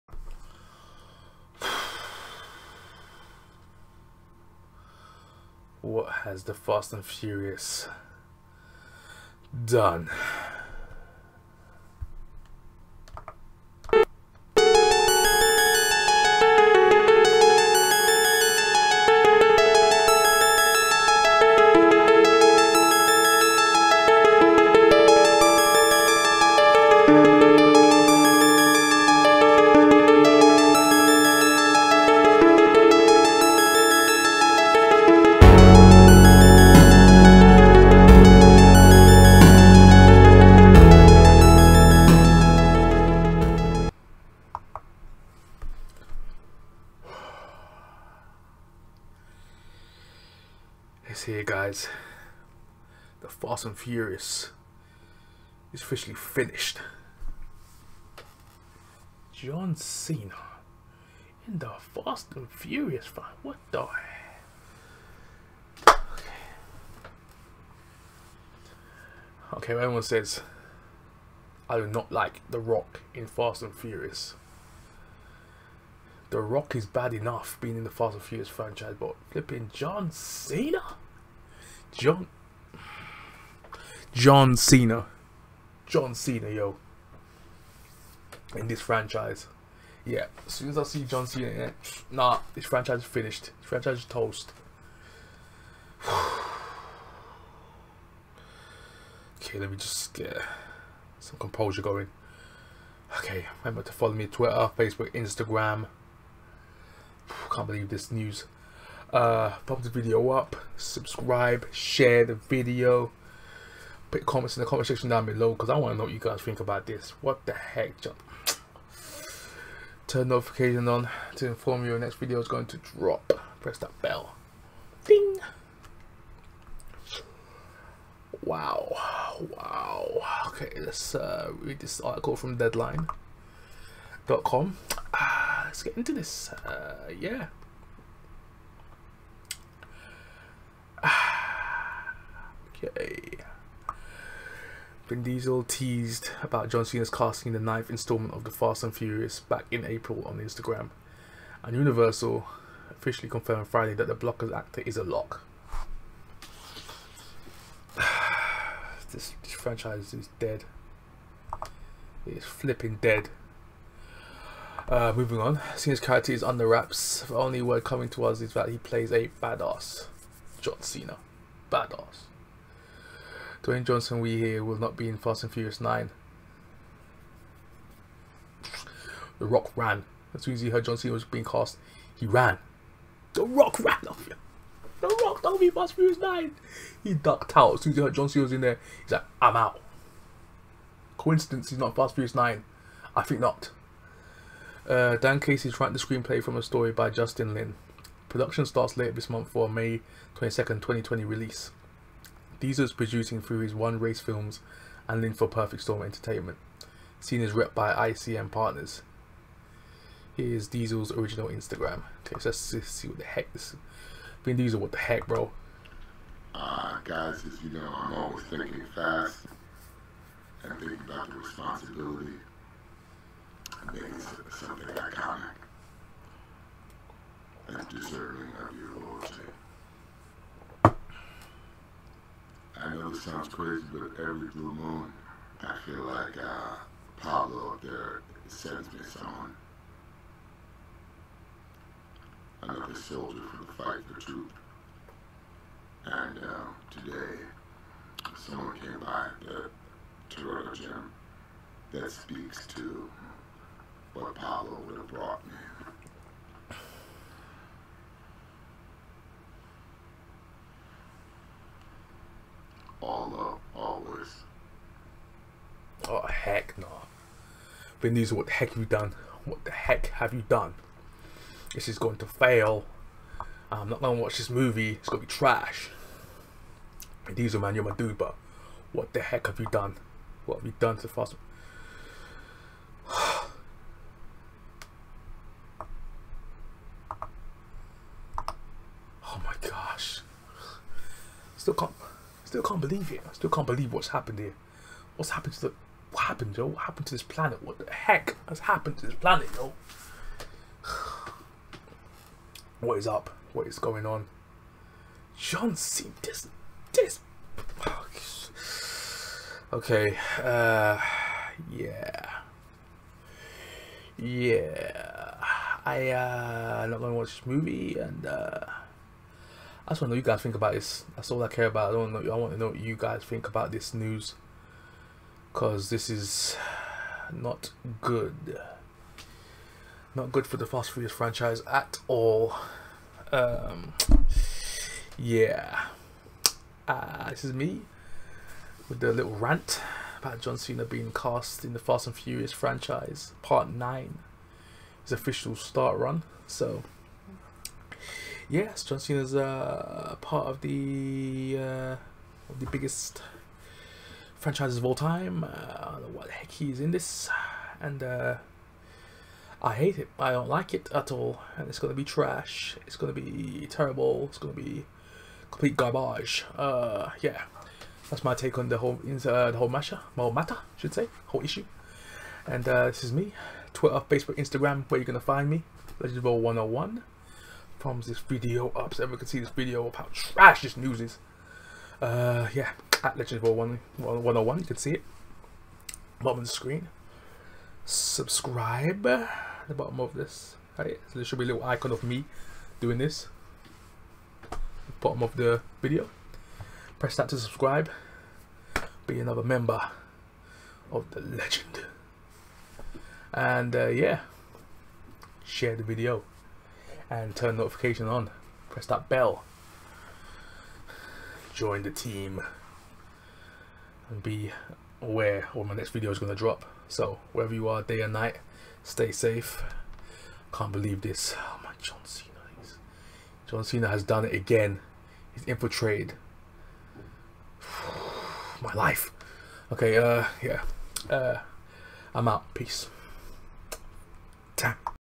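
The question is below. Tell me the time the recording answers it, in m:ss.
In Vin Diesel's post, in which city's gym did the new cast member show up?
4:10.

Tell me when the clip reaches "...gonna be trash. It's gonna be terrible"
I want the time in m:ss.
6:01.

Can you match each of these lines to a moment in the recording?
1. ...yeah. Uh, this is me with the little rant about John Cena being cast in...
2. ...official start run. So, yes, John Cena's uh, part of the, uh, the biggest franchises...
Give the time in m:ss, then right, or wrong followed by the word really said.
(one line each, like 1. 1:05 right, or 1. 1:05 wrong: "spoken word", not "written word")
1. 5:35 right
2. 5:45 right.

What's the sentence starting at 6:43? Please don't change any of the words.
And uh, yeah, share the video and turn notification on.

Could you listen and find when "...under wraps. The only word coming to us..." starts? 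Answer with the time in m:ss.
2:46.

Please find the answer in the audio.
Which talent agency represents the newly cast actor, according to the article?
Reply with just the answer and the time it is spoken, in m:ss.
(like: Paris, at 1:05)
ICM Partners, at 3:28.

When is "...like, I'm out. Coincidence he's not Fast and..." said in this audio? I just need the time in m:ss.
3:09.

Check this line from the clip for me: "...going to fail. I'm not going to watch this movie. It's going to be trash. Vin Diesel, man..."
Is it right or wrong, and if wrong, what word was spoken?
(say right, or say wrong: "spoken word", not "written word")
right.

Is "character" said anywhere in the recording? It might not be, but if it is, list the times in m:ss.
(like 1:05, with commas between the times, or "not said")
2:45.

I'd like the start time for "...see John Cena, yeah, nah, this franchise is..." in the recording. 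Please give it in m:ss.
1:30.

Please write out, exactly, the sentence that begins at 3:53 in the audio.
sounds crazy, but every blue moon, I feel like uh, Pablo up there sends me someone.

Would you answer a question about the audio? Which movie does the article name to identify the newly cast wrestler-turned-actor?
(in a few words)
Blockers.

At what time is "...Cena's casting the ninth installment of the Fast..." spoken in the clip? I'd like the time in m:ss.
2:26.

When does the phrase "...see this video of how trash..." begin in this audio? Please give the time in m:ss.
6:19.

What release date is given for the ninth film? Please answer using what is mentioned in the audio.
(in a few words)
May 22nd, 2020.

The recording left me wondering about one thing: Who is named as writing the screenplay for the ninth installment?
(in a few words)
Dan Casey.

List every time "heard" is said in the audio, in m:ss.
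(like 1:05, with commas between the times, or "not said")
3:00, 3:08.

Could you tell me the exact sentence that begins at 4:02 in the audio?
Another soldier for the fight for truth.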